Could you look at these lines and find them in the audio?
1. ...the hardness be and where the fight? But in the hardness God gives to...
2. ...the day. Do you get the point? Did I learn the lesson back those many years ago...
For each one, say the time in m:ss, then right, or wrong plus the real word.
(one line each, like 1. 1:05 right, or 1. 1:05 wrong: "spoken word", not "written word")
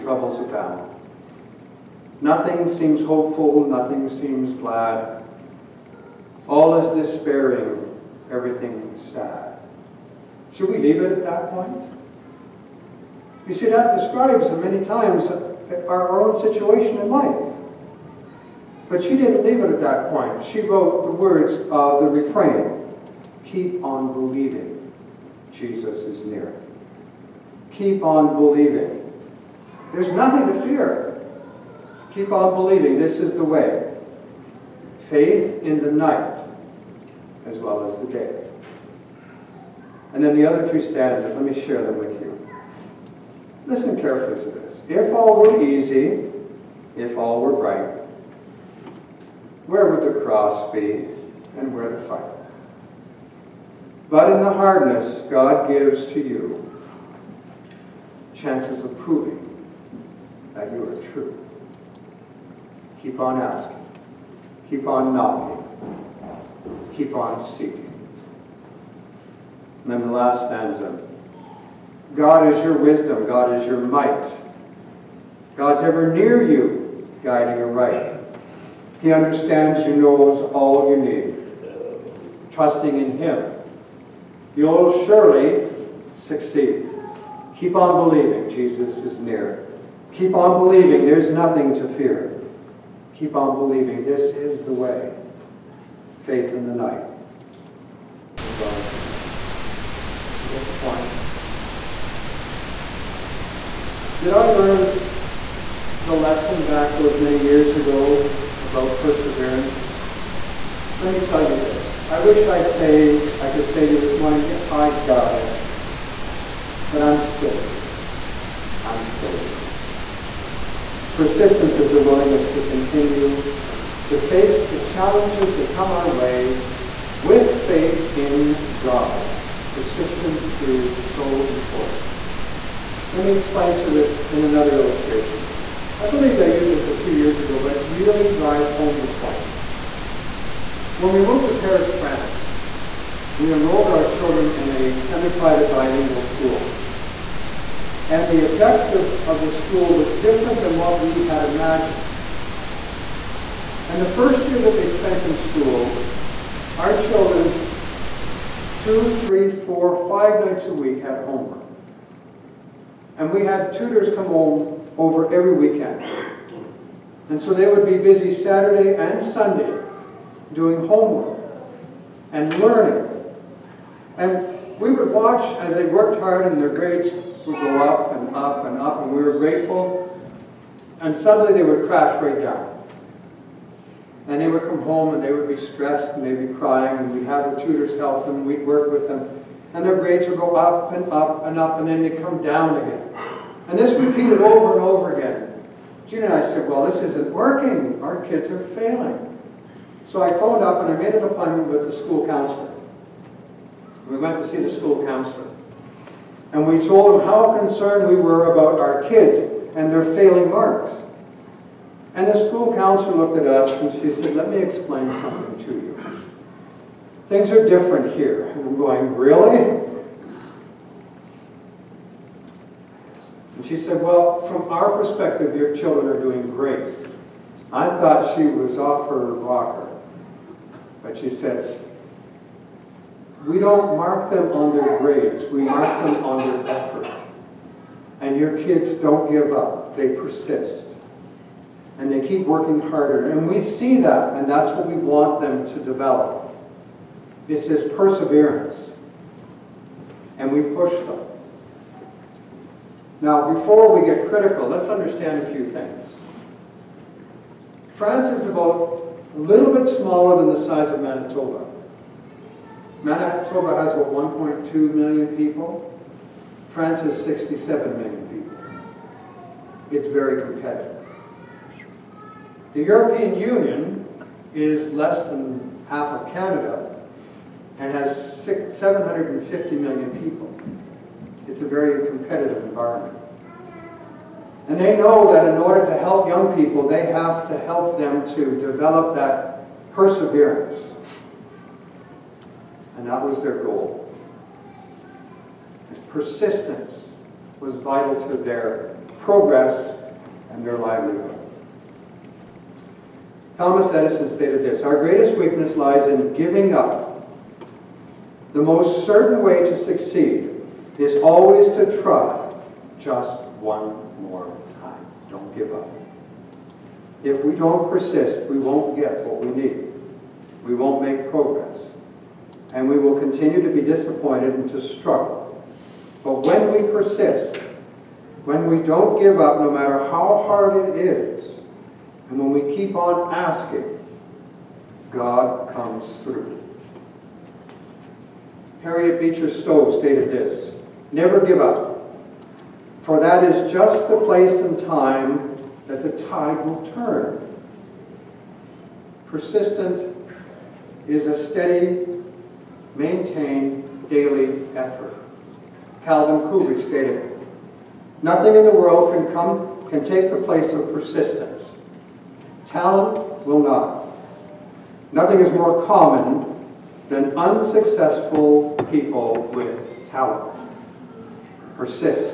1. 0:50 wrong: "cross", not "hardness"
2. 1:38 right.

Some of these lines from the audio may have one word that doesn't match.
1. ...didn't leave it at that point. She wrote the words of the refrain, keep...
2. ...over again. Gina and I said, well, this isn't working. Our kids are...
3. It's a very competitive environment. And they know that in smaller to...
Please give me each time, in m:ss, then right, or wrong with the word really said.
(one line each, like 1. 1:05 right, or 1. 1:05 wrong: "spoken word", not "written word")
1. 0:19 right
2. 3:14 right
3. 4:41 wrong: "order", not "smaller".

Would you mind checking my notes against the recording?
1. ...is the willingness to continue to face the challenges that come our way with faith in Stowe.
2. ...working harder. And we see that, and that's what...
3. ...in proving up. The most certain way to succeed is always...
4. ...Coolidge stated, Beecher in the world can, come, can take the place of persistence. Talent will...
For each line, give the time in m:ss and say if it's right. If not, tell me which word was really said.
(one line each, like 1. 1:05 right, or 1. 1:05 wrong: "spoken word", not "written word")
1. 2:01 wrong: "God", not "Stowe"
2. 4:02 right
3. 5:06 wrong: "giving", not "proving"
4. 5:56 wrong: "Nothing", not "Beecher".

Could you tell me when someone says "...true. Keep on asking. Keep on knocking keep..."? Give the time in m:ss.
1:01.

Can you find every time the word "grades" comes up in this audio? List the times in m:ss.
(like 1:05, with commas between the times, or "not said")
2:56, 3:09, 3:54.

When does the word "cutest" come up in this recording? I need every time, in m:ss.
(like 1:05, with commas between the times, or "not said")
not said.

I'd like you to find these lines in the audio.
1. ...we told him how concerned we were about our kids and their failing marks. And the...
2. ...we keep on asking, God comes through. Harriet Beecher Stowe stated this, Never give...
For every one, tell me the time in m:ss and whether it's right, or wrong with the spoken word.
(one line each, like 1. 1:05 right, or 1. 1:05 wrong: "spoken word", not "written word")
1. 3:26 right
2. 5:32 right.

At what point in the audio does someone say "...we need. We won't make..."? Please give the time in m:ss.
5:19.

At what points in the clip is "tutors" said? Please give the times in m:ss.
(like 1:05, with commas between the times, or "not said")
2:43, 3:07.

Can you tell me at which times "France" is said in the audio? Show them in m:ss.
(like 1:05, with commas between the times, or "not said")
2:21, 4:17, 4:26.